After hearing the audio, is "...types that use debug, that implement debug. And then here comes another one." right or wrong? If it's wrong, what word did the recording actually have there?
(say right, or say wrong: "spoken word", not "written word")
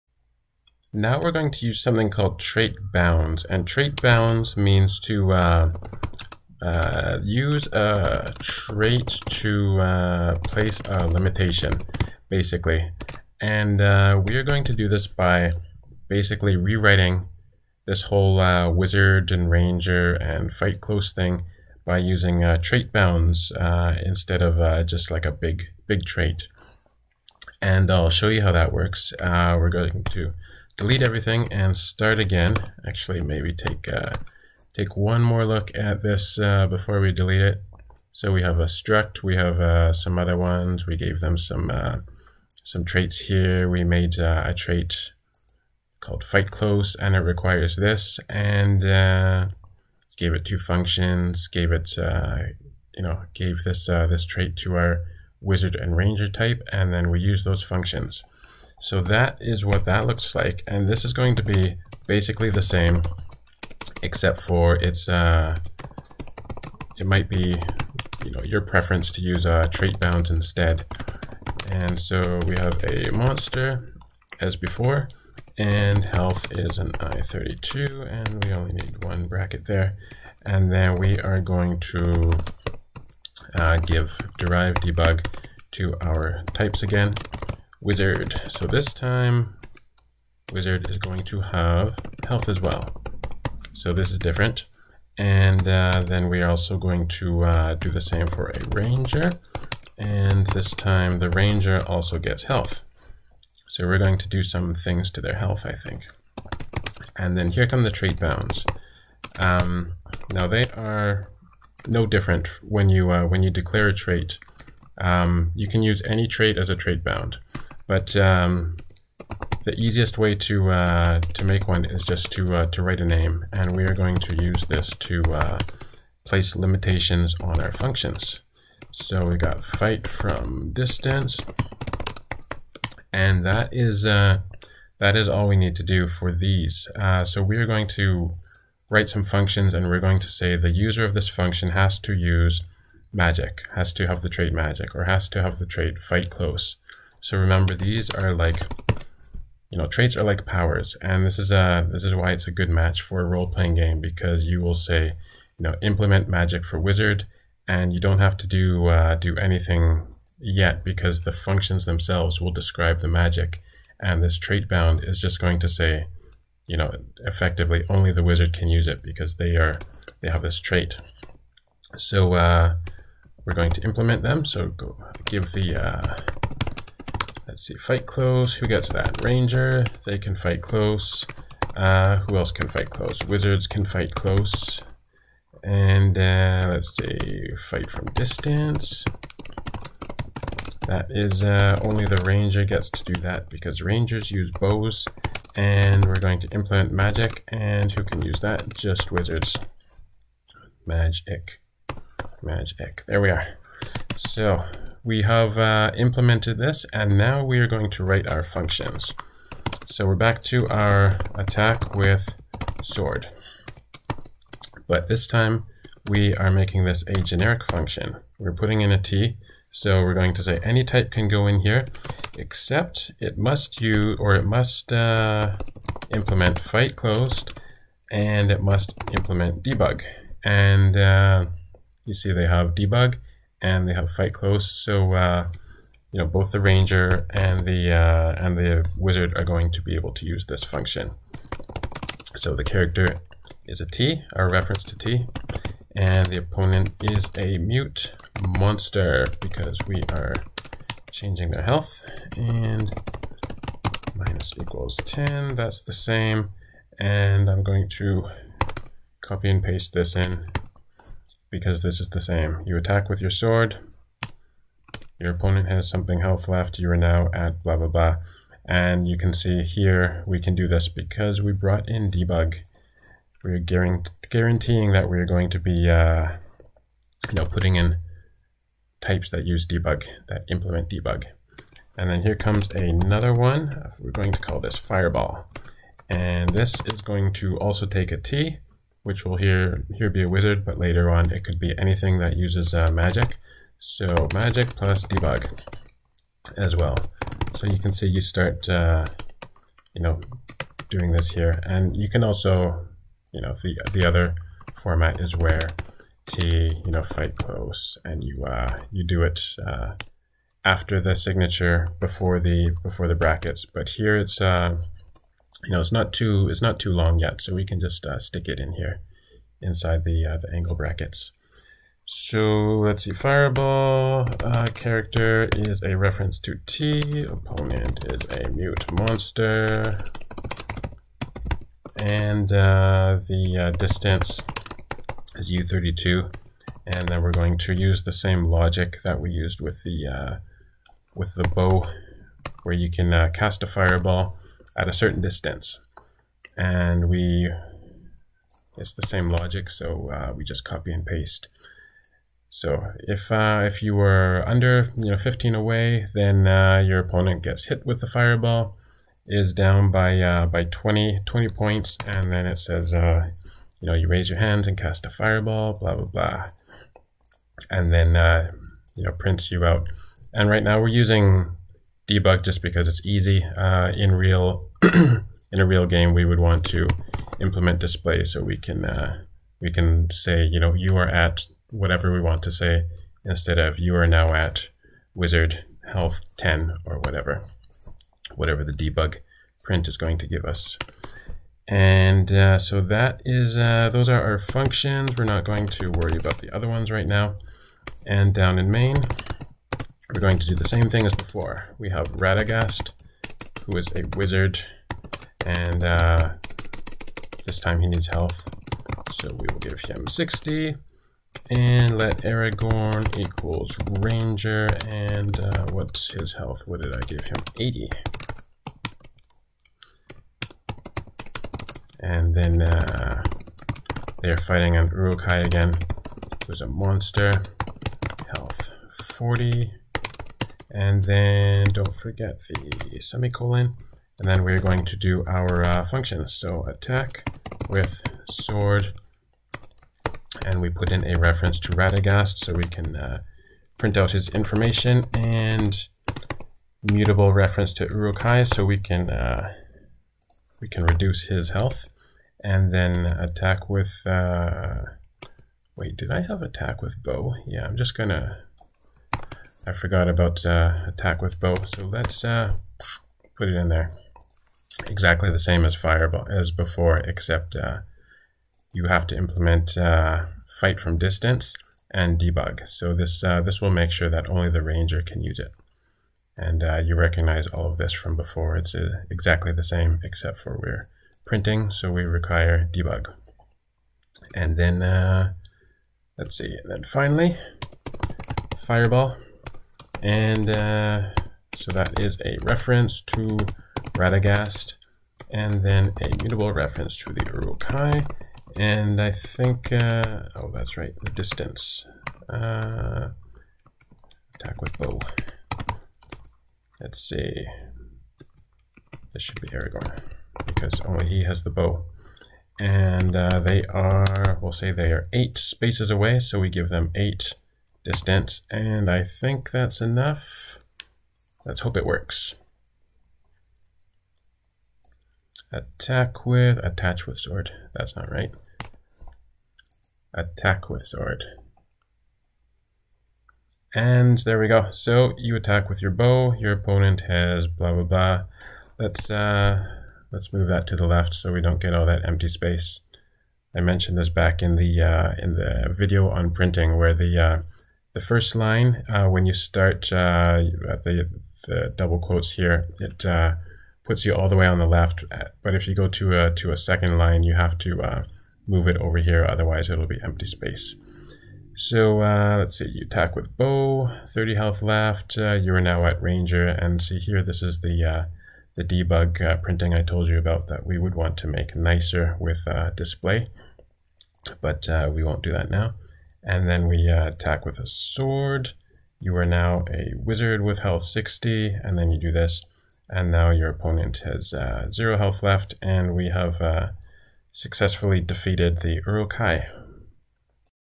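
right.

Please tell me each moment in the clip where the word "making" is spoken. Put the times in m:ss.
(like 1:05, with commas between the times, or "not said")
3:36.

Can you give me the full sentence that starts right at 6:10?
And right now we're using debug just because it's easy.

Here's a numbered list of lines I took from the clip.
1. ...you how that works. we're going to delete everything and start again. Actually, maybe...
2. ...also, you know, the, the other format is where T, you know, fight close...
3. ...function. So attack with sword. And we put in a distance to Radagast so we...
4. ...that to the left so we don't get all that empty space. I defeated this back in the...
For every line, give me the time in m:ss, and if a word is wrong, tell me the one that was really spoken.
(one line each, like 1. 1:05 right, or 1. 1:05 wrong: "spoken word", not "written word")
1. 0:28 right
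2. 5:02 right
3. 7:15 wrong: "reference", not "distance"
4. 9:00 wrong: "mentioned", not "defeated".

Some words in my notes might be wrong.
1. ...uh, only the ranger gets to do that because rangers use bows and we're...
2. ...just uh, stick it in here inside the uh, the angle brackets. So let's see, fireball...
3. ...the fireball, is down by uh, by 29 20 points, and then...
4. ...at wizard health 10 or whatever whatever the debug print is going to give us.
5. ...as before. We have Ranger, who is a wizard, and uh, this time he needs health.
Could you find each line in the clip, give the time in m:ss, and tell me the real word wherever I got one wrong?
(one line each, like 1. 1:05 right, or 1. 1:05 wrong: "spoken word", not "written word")
1. 3:11 right
2. 5:17 right
3. 5:58 wrong: "20", not "29"
4. 6:24 right
5. 6:41 wrong: "Radagast", not "Ranger".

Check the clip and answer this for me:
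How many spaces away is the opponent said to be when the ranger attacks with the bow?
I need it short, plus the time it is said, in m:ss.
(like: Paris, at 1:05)
8, at 8:35.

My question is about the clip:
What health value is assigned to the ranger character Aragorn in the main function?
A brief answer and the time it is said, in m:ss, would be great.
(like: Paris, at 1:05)
80, at 6:57.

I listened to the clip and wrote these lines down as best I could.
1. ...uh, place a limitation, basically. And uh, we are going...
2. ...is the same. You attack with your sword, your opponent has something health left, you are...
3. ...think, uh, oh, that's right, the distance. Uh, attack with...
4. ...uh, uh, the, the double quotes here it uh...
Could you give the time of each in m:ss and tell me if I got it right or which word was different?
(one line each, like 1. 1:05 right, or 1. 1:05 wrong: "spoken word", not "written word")
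1. 0:09 right
2. 4:21 right
3. 8:19 right
4. 9:09 right.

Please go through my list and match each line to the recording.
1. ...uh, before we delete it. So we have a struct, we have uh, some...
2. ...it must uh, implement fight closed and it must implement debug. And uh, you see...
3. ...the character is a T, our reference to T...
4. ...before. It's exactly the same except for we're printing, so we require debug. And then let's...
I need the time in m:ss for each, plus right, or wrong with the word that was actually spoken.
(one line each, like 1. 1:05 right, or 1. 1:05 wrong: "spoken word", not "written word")
1. 0:36 right
2. 3:44 right
3. 4:02 right
4. 7:58 right.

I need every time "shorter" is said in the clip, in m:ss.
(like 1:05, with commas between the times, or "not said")
not said.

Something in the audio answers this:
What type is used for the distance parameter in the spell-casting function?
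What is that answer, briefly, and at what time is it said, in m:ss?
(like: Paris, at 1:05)
u32, at 5:35.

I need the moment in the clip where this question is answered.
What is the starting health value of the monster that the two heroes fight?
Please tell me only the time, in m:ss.
7:08.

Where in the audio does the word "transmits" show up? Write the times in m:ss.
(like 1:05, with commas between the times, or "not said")
not said.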